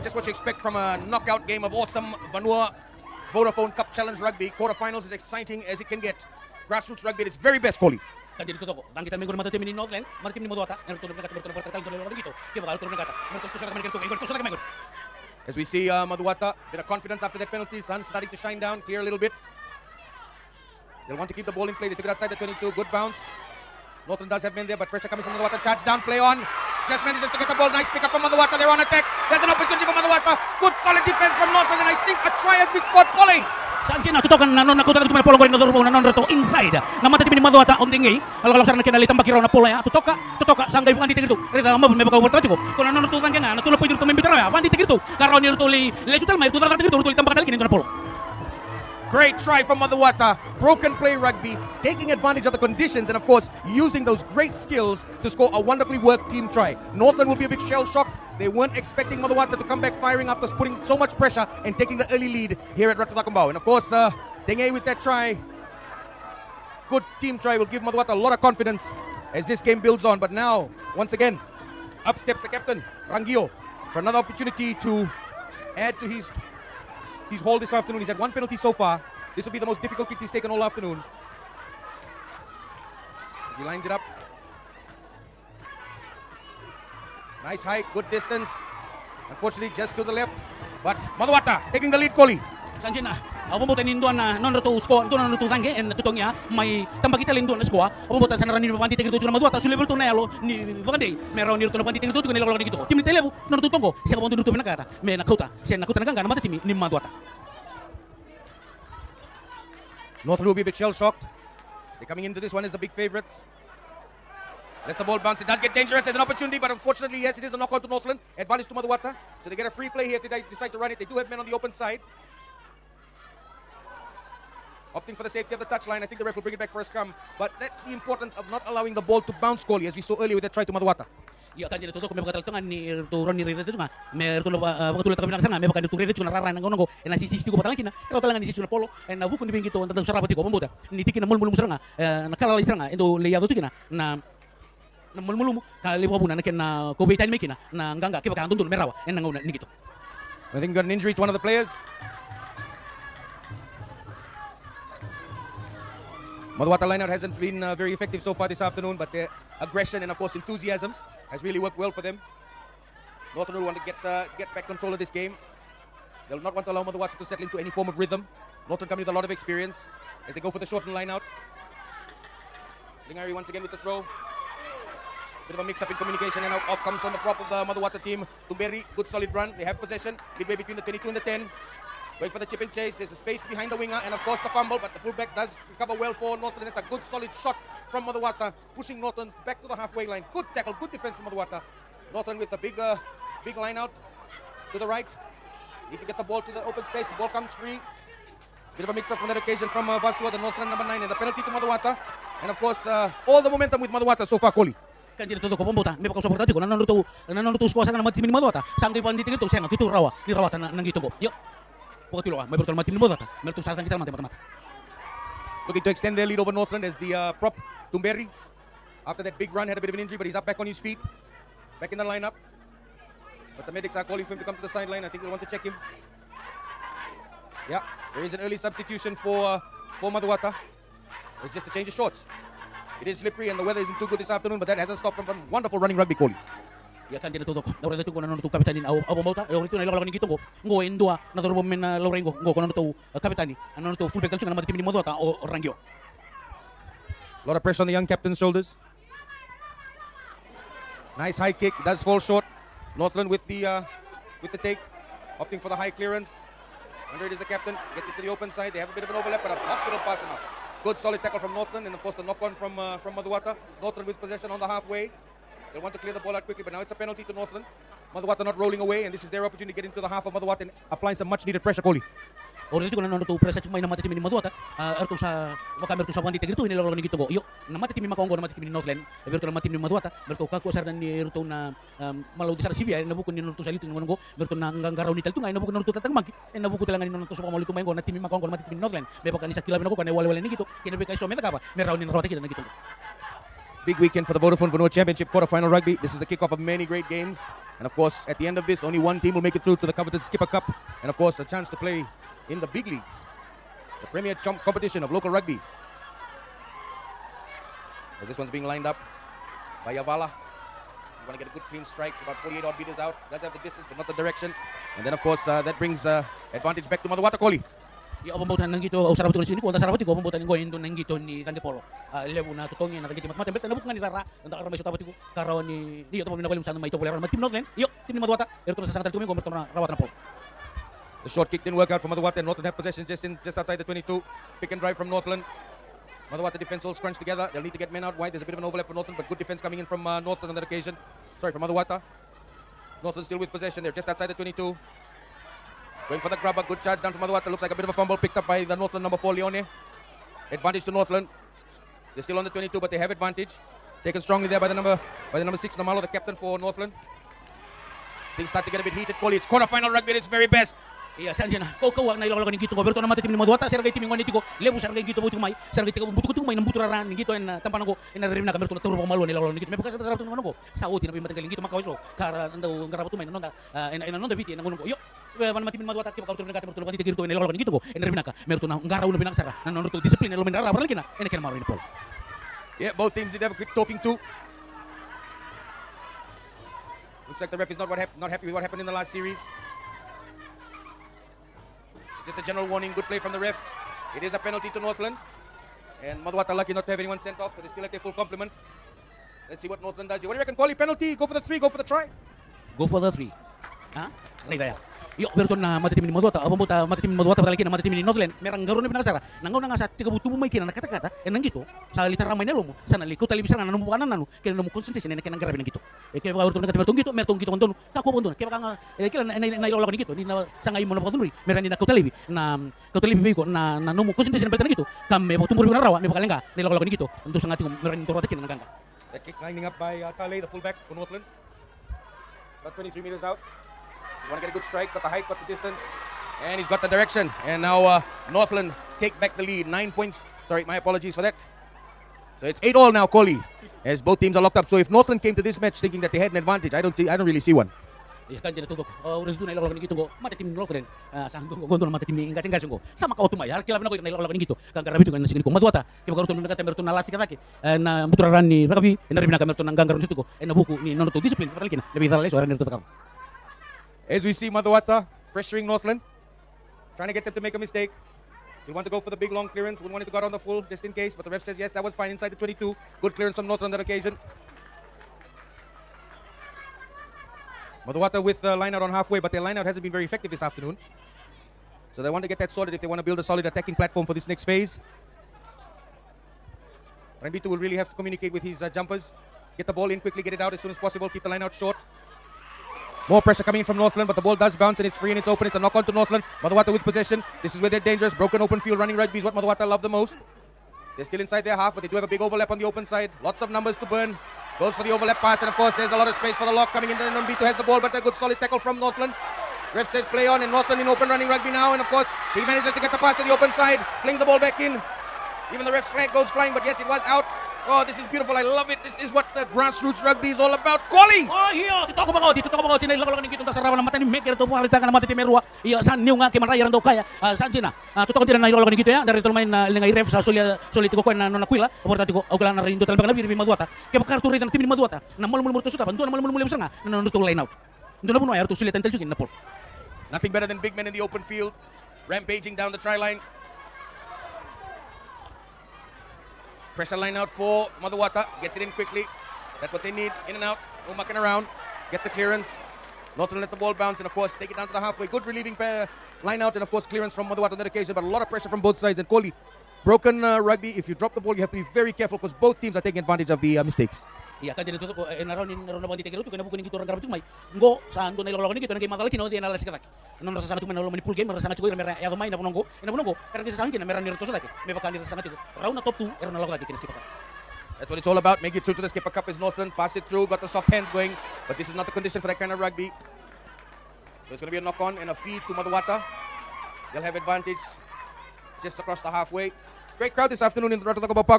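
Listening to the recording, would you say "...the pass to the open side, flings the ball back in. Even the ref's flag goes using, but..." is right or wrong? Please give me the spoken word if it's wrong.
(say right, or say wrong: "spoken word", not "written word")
wrong: "flying", not "using".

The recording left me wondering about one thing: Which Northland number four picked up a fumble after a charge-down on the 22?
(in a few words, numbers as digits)
Leone.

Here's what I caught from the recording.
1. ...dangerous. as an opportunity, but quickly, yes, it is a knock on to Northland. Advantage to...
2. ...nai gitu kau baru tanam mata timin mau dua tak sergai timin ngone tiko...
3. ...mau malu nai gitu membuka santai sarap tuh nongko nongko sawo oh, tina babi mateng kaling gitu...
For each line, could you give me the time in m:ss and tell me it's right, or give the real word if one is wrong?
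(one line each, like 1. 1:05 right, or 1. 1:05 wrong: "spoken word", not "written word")
1. 1:55 wrong: "unfortunately", not "quickly"
2. 6:02 right
3. 6:08 right.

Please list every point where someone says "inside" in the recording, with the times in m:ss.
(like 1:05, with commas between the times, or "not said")
0:36, 7:52, 8:21.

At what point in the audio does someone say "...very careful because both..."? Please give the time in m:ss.
9:21.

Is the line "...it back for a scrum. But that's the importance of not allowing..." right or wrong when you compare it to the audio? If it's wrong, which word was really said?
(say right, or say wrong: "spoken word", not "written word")
right.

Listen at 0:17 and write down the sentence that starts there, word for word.
Sun starting to shine down, clear a little bit.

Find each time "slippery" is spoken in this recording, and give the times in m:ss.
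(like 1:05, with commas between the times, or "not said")
3:53.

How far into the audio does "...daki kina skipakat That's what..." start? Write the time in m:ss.
9:36.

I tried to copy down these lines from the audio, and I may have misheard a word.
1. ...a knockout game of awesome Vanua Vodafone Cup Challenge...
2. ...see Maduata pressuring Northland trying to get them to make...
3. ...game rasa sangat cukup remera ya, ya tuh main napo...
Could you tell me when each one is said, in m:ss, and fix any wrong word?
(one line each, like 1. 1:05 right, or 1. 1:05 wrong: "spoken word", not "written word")
1. 0:00 right
2. 7:44 right
3. 9:31 right.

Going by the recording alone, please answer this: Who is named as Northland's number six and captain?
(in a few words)
Namalo.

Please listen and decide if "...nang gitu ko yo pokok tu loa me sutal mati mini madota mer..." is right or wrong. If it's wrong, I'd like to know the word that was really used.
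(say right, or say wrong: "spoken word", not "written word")
wrong: "portal", not "sutal".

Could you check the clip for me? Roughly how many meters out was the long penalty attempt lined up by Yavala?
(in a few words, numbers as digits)
48.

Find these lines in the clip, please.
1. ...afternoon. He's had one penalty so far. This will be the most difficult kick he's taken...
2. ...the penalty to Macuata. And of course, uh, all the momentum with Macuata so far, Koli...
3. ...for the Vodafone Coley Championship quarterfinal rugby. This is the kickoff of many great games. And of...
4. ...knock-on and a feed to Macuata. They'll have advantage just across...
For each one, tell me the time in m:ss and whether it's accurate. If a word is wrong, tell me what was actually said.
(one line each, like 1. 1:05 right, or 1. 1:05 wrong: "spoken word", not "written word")
1. 1:17 right
2. 3:21 right
3. 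4:54 wrong: "Vanua", not "Coley"
4. 9:44 right.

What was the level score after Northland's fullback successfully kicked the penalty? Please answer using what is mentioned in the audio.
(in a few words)
8 all.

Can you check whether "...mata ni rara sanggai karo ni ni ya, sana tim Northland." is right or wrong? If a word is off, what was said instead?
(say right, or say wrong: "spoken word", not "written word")
wrong: "ramai", not "sanggai".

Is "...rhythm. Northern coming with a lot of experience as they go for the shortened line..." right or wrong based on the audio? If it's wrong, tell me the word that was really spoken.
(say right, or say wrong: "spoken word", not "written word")
right.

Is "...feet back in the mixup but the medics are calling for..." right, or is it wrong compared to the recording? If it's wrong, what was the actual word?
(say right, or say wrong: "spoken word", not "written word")
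wrong: "lineup", not "mixup".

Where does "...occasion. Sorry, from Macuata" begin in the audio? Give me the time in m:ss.
5:40.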